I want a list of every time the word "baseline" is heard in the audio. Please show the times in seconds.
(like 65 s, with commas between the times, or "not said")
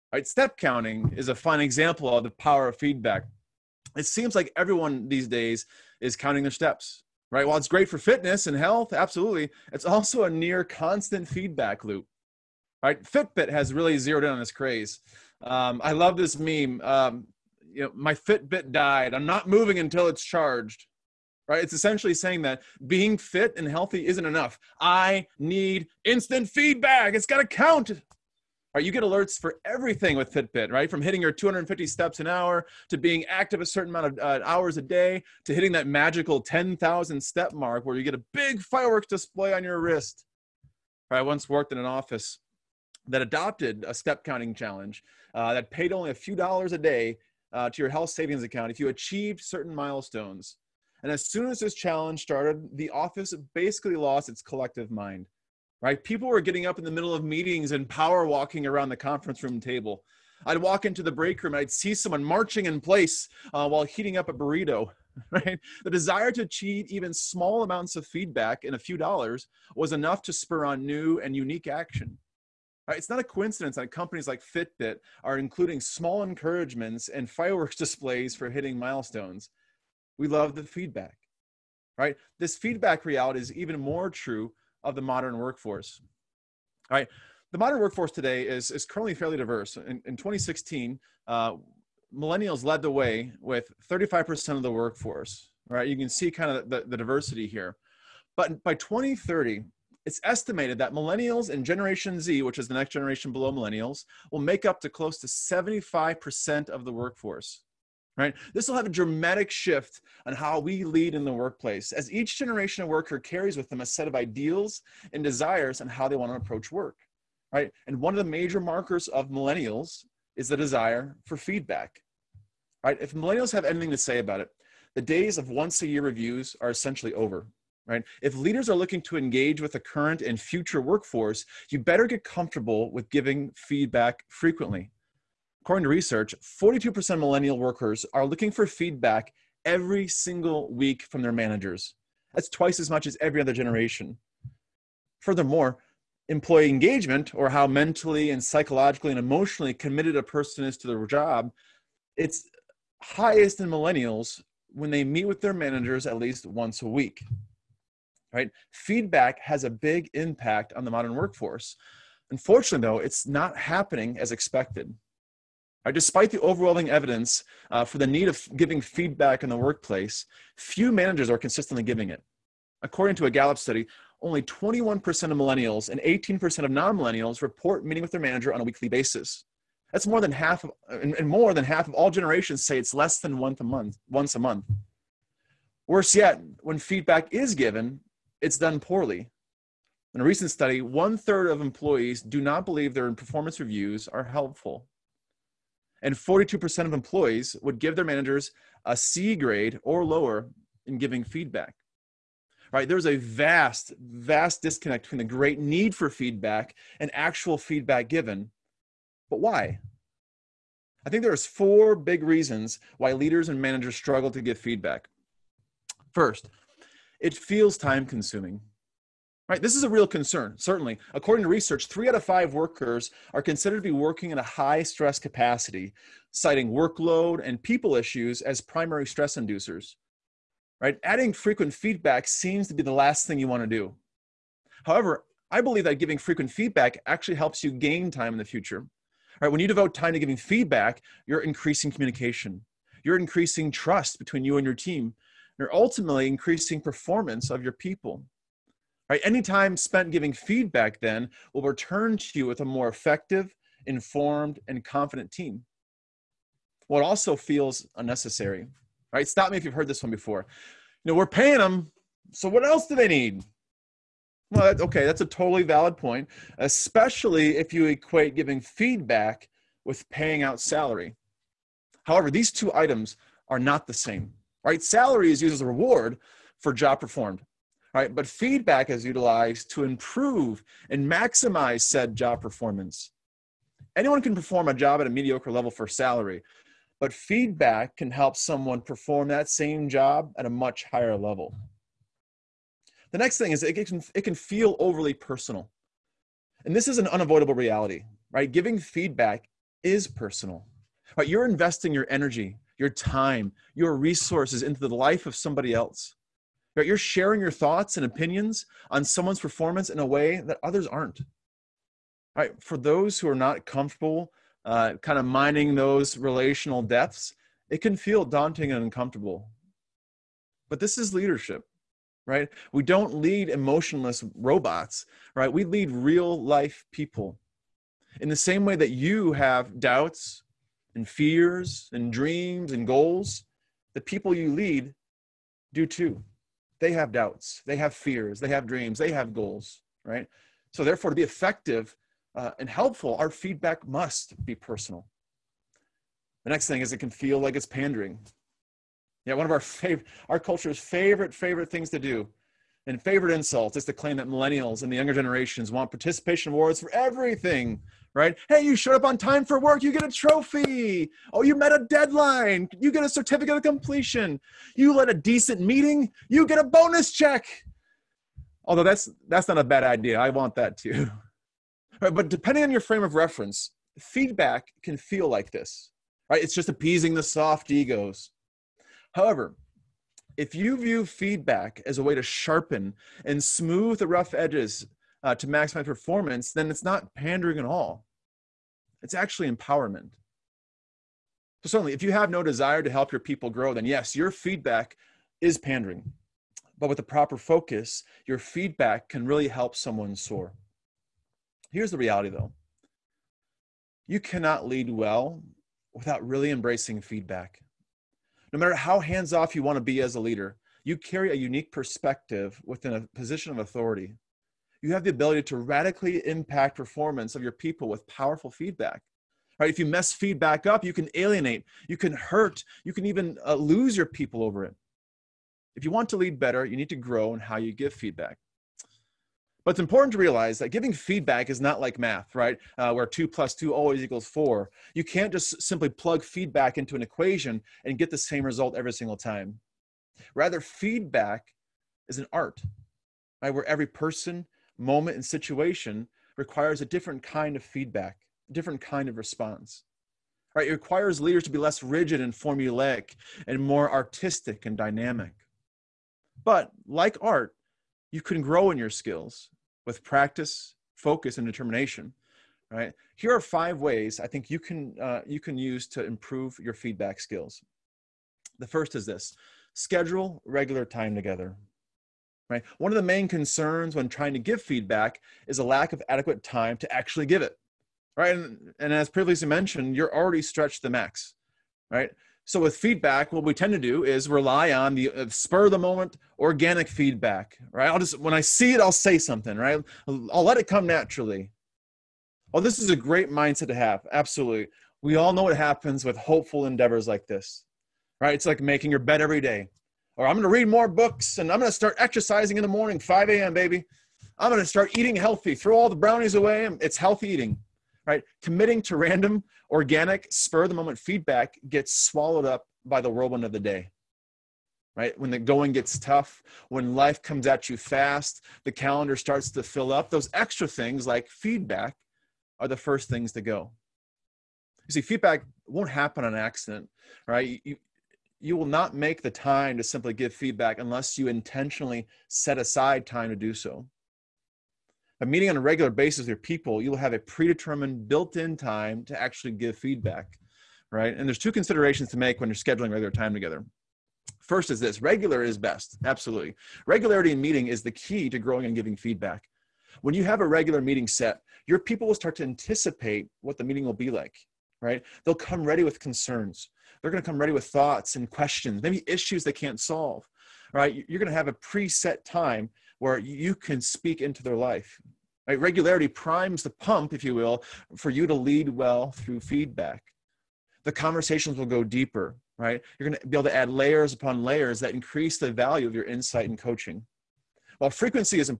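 not said.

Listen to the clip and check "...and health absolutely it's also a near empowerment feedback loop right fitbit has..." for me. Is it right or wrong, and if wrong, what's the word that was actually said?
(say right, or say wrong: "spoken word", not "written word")
wrong: "constant", not "empowerment".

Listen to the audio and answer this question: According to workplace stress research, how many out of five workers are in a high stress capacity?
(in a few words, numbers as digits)
3.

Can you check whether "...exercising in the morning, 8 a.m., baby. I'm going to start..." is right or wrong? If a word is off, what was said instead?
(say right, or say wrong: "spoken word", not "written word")
wrong: "5", not "8".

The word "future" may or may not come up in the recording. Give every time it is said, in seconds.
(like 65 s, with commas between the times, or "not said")
130 s, 238 s.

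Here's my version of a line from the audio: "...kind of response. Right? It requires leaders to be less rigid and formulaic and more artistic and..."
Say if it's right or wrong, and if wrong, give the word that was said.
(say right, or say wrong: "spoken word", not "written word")
right.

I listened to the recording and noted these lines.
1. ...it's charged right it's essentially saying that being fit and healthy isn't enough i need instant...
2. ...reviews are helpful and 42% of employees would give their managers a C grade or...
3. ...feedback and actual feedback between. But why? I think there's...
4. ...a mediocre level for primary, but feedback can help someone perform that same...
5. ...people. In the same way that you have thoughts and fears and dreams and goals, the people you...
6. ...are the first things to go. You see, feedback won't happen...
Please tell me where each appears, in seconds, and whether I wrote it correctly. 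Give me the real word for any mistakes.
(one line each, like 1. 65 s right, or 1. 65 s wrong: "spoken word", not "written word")
1. 20 s right
2. 193 s right
3. 206 s wrong: "given", not "between"
4. 285 s wrong: "salary", not "primary"
5. 326 s wrong: "doubts", not "thoughts"
6. 522 s right.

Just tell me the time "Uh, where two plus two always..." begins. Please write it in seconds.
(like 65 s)
432 s.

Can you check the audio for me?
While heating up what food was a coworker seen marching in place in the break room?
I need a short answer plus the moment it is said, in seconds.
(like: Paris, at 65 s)
Burrito, at 64 s.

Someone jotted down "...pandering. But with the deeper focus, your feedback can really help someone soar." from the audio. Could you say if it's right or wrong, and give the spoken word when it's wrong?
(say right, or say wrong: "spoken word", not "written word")
wrong: "proper", not "deeper".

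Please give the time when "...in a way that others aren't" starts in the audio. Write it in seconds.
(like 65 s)
309 s.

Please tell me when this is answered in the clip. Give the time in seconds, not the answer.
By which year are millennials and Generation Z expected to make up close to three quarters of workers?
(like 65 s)
98 s.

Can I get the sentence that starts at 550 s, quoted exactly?
When you have a regular meeting set, your people will start to anticipate what the meeting will be like, right?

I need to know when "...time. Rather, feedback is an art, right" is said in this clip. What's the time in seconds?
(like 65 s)
439 s.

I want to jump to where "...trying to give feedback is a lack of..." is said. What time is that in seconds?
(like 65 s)
474 s.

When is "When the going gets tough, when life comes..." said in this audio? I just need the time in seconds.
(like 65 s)
515 s.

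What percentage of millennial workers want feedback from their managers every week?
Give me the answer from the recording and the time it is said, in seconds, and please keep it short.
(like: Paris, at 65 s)
42%, at 136 s.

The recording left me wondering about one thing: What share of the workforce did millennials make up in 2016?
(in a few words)
35%.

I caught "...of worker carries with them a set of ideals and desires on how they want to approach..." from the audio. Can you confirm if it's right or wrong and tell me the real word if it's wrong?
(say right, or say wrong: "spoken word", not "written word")
right.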